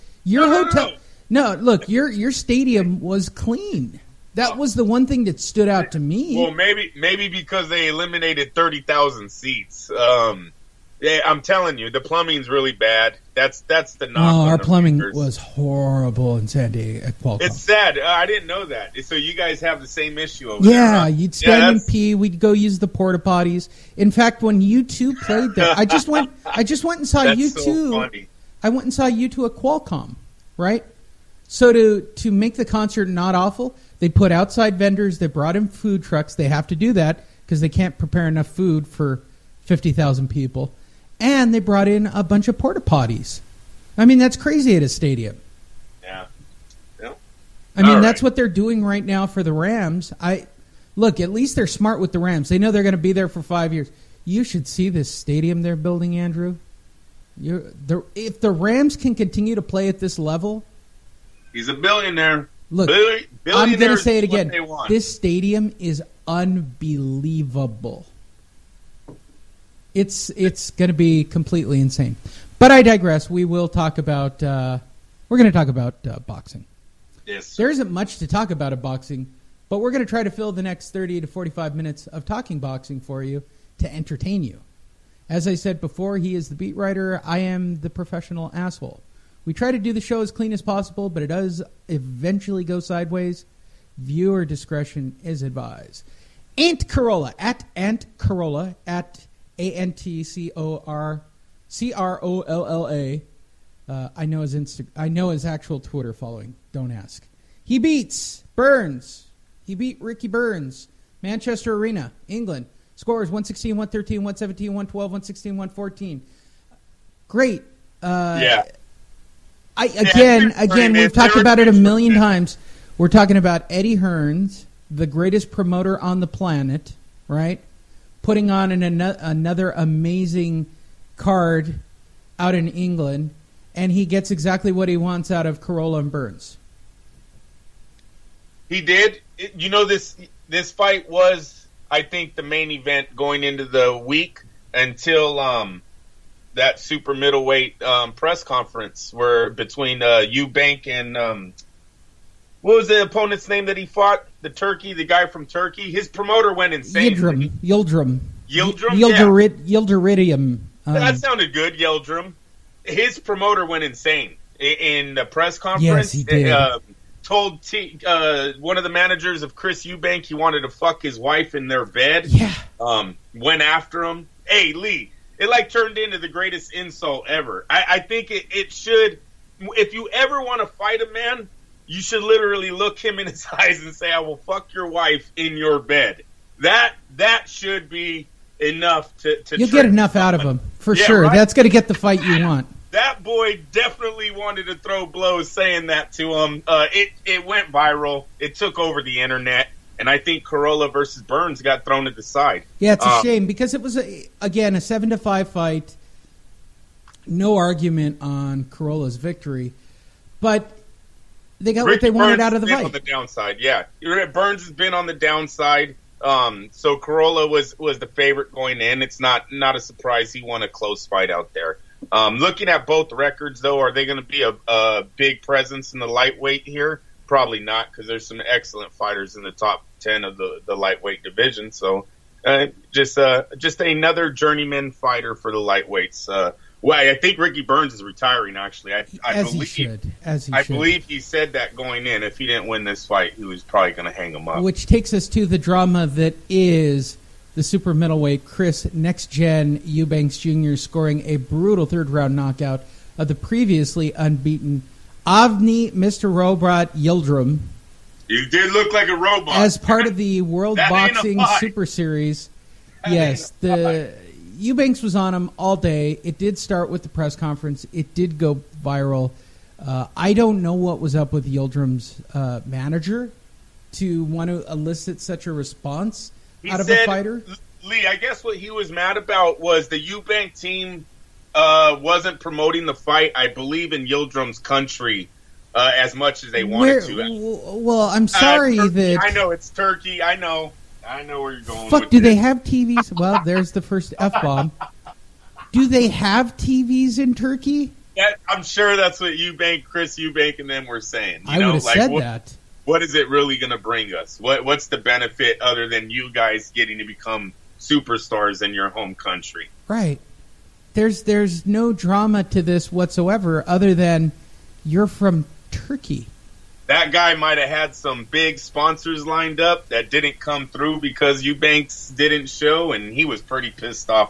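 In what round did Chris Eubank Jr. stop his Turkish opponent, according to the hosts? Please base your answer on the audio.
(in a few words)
third round.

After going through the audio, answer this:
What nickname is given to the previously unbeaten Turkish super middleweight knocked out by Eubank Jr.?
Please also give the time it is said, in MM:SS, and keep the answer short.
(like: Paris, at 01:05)
Mr. Robot, at 04:15.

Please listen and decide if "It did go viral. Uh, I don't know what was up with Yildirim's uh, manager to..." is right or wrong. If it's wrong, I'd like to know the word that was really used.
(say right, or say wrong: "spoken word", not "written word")
right.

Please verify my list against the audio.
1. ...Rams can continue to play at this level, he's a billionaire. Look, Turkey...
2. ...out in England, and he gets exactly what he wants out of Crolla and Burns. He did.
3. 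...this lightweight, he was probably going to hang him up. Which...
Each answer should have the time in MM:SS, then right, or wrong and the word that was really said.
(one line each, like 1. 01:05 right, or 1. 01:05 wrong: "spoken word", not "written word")
1. 00:58 wrong: "Billi", not "Turkey"
2. 02:12 right
3. 04:02 wrong: "fight", not "lightweight".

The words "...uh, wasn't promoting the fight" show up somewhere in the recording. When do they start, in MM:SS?
04:41.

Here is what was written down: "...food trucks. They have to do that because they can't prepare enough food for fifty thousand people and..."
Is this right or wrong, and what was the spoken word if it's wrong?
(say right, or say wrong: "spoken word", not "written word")
right.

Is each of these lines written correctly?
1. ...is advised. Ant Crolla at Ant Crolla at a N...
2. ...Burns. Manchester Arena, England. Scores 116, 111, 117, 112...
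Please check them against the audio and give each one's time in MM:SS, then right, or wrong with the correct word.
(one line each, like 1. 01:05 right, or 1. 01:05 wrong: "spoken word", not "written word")
1. 01:35 right
2. 01:50 wrong: "113", not "111".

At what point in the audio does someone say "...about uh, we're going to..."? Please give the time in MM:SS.
01:13.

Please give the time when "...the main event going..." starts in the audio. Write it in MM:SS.
02:22.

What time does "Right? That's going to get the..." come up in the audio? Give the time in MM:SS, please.
03:11.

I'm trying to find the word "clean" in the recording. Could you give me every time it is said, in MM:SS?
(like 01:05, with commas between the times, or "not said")
00:03, 01:30.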